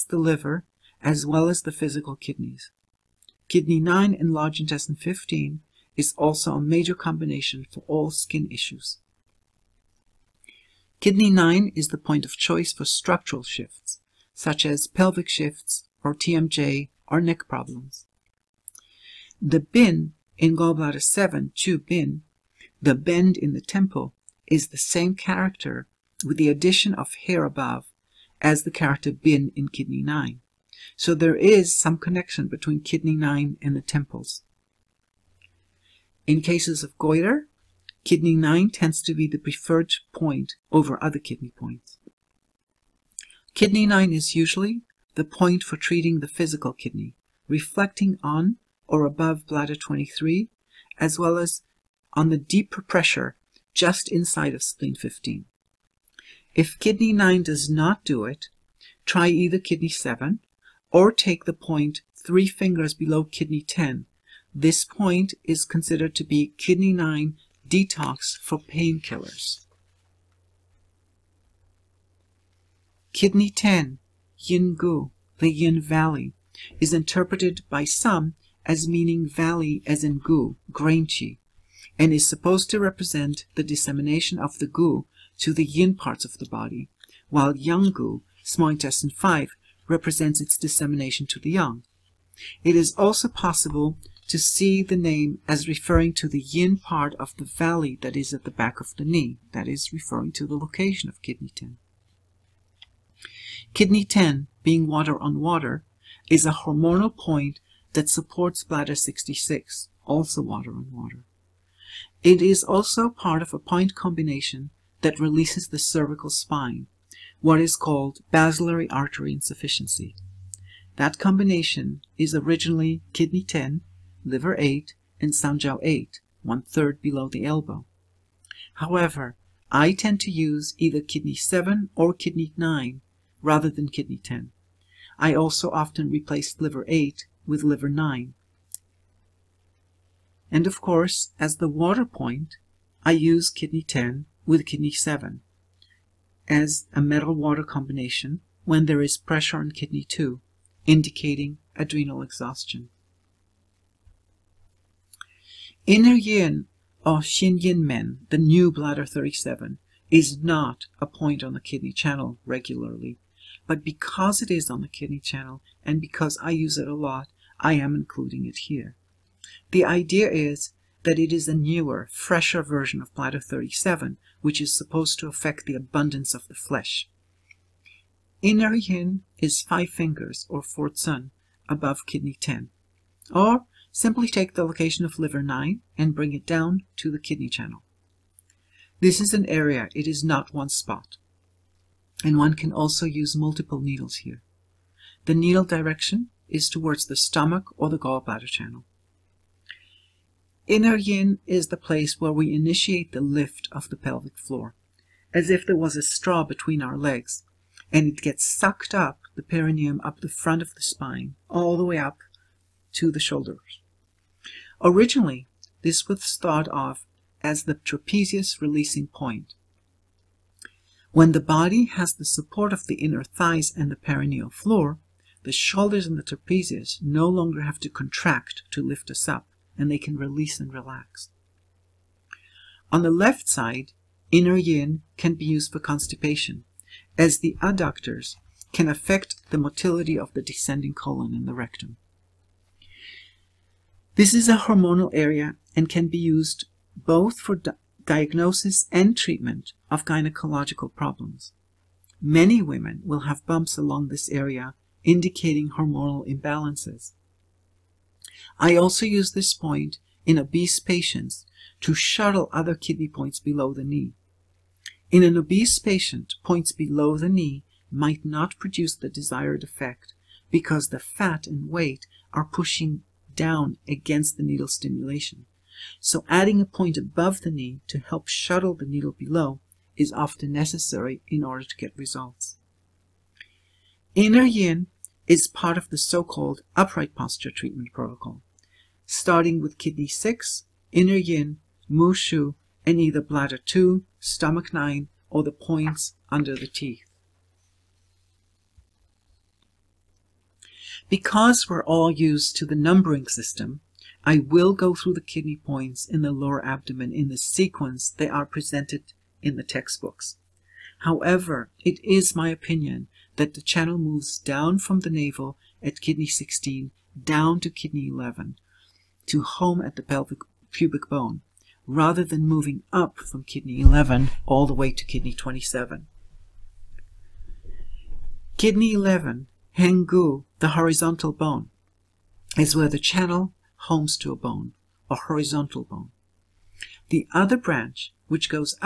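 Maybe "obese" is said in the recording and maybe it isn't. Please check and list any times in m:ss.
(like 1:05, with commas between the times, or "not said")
4:20, 4:25.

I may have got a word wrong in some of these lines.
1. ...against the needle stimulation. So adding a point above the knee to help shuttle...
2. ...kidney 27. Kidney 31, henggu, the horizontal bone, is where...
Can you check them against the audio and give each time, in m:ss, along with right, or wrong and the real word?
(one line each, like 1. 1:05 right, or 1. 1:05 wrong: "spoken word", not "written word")
1. 4:33 right
2. 5:25 wrong: "11", not "31".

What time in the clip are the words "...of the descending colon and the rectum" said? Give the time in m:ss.
4:00.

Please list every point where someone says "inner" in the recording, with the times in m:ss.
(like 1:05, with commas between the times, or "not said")
2:35, 2:58, 3:20, 3:43, 3:54, 4:44, 4:50.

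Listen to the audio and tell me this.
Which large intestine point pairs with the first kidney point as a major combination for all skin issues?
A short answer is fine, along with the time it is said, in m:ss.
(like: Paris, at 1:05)
Large intestine 15, at 0:04.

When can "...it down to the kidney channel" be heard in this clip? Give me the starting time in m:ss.
3:06.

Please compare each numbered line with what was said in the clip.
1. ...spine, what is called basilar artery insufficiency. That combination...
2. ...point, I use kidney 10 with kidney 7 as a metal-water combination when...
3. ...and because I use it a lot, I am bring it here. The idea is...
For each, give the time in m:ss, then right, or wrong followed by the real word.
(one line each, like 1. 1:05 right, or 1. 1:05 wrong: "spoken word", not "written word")
1. 1:56 right
2. 2:22 right
3. 2:45 wrong: "including", not "bring".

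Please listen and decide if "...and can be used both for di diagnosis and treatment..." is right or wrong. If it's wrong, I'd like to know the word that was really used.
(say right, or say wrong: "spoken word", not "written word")
right.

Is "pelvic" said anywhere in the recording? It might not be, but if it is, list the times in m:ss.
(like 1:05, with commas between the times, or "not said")
0:14, 3:23, 5:20.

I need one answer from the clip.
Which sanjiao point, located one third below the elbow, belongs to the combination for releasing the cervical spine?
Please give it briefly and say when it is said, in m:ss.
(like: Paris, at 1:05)
Sanjiao 8, at 2:05.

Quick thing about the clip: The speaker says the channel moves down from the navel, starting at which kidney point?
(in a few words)
Kidney 16.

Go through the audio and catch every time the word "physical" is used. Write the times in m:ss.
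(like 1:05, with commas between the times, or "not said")
0:01, 0:46.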